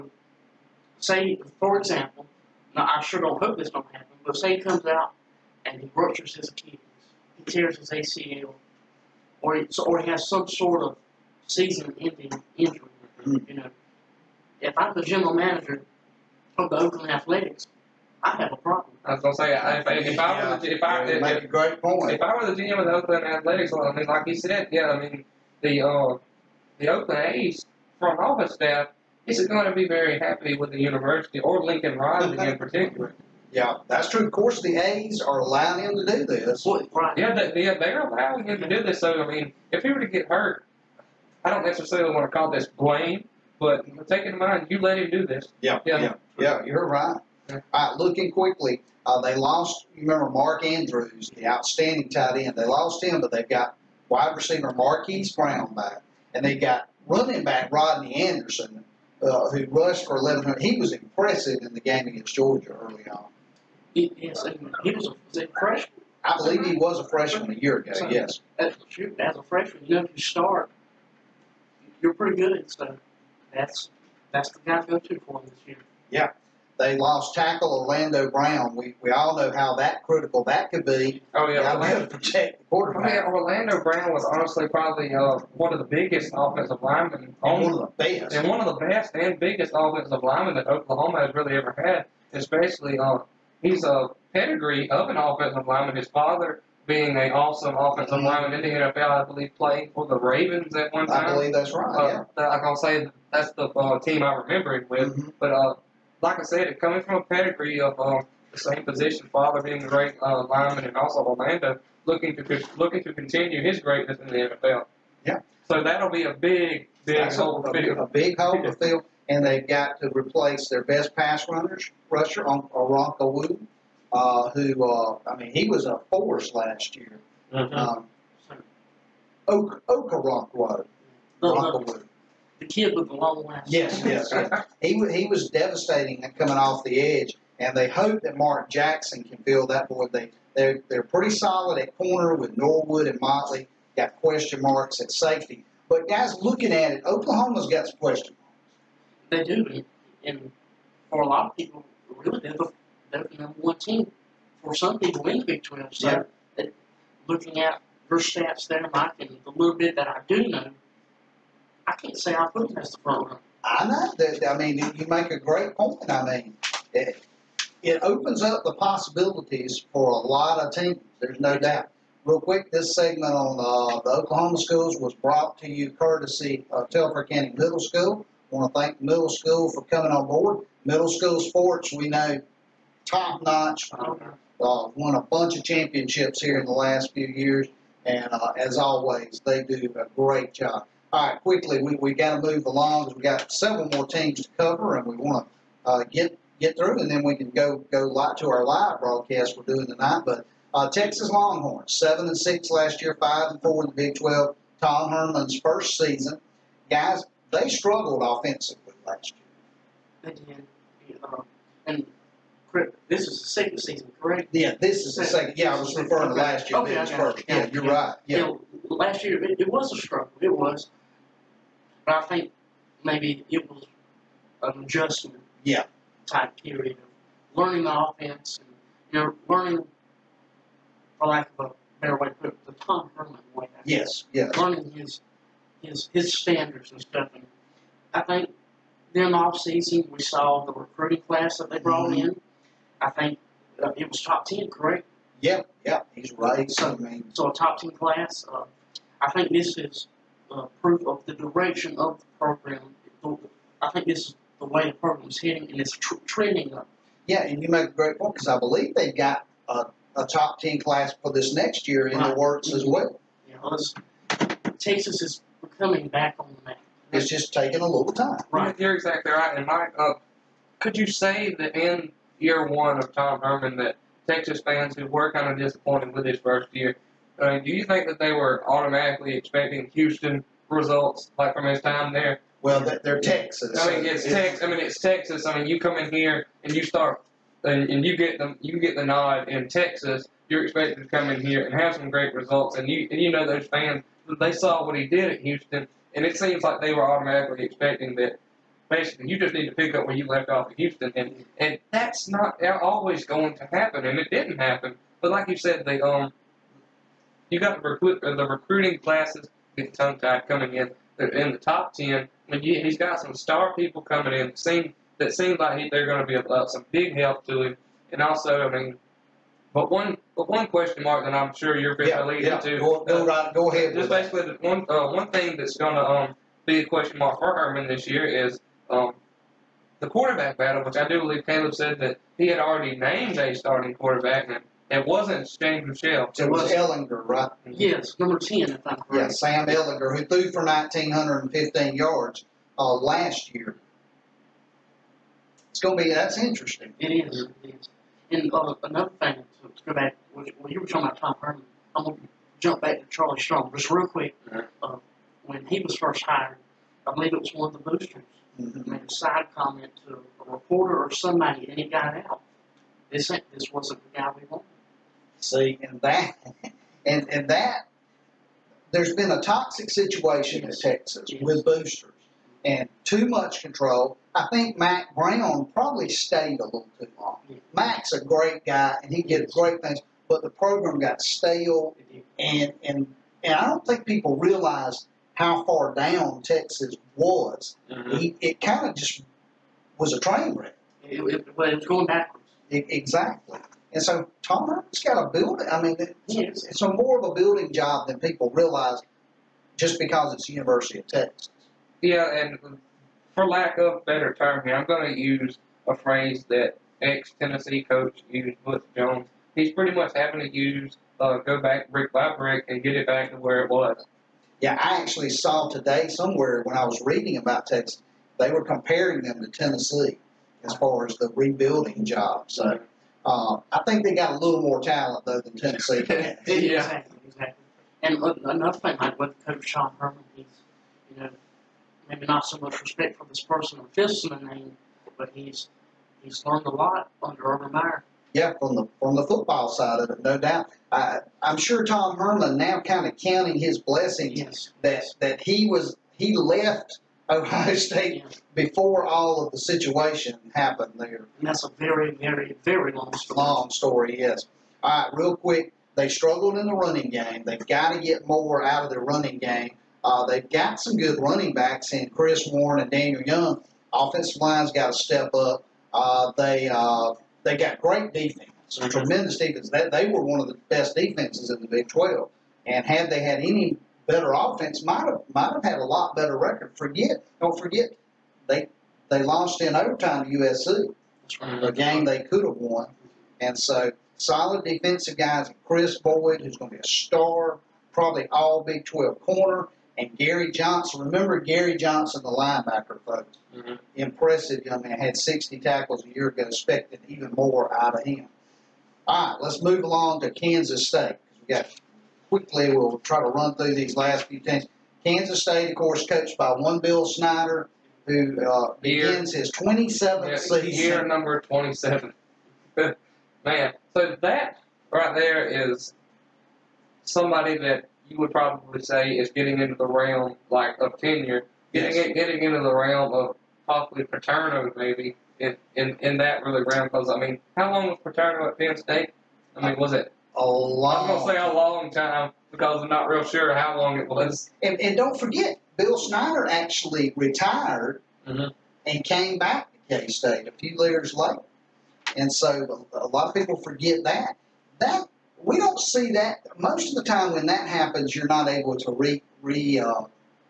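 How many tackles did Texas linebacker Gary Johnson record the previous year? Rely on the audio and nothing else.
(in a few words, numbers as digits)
60.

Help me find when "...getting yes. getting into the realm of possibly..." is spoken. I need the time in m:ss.
8:41.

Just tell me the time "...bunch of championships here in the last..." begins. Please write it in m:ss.
3:05.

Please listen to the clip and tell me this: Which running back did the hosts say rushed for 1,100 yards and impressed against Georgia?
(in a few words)
Rodney Anderson.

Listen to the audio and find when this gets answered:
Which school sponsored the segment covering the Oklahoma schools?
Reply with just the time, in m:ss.
2:56.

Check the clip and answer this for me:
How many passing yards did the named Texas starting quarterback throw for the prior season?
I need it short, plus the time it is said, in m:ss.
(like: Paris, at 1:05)
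1,915, at 5:40.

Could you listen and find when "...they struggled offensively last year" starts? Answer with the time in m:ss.
3:27.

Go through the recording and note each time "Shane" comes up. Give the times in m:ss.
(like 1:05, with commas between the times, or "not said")
5:35.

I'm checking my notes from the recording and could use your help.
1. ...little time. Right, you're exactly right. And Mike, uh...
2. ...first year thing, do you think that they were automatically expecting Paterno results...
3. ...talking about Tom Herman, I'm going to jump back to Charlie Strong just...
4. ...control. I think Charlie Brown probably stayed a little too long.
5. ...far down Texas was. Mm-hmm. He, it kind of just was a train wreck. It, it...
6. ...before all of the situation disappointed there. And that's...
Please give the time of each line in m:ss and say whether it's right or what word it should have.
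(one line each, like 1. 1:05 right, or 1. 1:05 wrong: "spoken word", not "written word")
1. 4:27 right
2. 4:36 wrong: "Houston", not "Paterno"
3. 5:50 right
4. 6:13 wrong: "Mack", not "Charlie"
5. 6:25 right
6. 7:28 wrong: "happened", not "disappointed".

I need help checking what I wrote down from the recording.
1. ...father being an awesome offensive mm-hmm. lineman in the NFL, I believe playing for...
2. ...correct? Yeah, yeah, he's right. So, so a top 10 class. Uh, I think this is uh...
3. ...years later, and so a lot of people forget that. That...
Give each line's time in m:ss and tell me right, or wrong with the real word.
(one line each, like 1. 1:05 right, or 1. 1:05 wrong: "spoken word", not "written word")
1. 1:36 right
2. 4:04 right
3. 9:00 right.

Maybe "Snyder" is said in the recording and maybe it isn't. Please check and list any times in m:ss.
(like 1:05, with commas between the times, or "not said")
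8:27, 8:55.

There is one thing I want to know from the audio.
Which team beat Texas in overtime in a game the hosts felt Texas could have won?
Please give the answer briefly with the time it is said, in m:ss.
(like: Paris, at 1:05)
USC, at 8:00.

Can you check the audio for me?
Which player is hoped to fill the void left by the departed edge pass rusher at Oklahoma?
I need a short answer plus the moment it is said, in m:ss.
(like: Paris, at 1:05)
Mark Jackson, at 2:18.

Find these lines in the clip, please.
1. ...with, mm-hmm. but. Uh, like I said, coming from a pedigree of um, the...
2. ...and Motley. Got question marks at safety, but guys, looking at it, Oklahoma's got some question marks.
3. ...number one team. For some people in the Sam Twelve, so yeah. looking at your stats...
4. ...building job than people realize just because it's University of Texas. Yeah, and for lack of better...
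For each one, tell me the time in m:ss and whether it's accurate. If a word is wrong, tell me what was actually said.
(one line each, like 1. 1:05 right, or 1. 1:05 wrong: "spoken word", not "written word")
1. 1:44 right
2. 2:23 right
3. 2:33 wrong: "Big", not "Sam"
4. 6:37 right.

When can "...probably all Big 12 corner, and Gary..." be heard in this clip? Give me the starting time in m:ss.
8:07.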